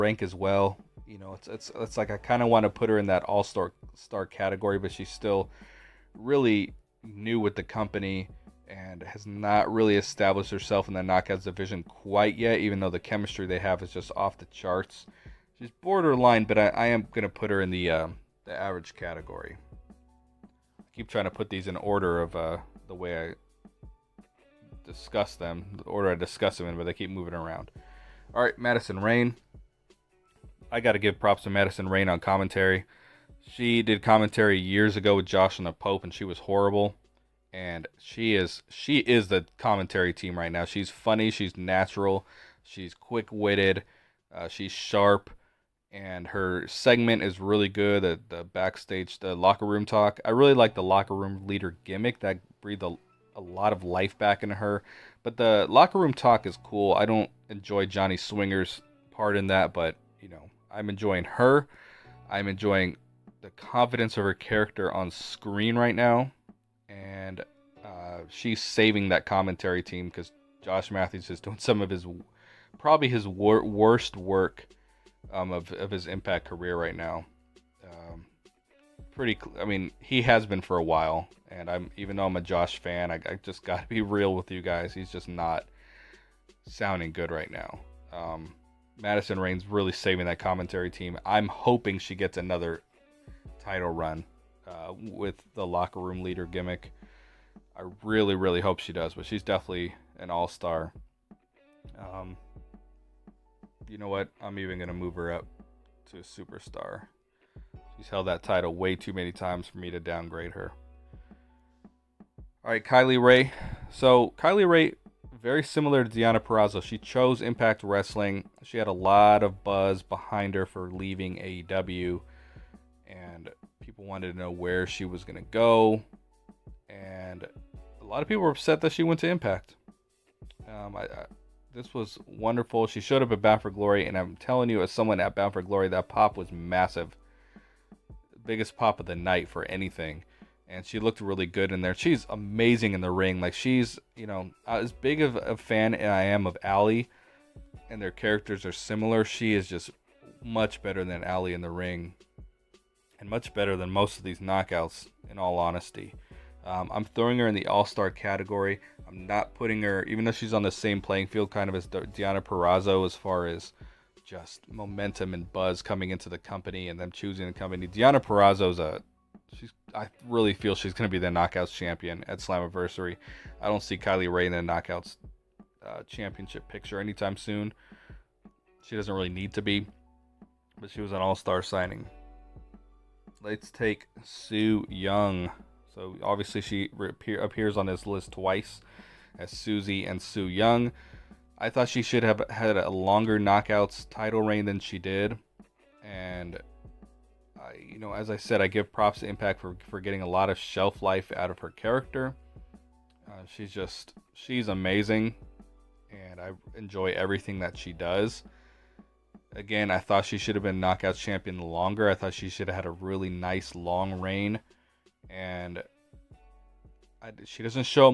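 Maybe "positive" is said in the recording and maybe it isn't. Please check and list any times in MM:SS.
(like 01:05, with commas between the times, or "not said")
not said.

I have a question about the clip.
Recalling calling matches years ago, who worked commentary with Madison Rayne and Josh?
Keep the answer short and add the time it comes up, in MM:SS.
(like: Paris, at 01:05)
the Pope, at 00:35.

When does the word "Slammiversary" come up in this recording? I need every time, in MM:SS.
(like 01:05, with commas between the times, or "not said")
02:52.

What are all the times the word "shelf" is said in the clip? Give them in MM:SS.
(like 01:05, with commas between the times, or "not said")
03:20.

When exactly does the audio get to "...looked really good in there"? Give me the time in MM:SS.
02:20.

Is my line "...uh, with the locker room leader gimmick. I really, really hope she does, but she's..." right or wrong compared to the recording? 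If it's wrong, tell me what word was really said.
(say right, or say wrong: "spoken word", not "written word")
right.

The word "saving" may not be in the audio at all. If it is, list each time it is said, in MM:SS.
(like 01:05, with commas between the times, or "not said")
01:08, 01:29.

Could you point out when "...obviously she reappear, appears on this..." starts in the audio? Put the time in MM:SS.
03:06.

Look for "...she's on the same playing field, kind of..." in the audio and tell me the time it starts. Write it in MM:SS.
02:40.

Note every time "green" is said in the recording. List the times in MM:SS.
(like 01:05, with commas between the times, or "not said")
not said.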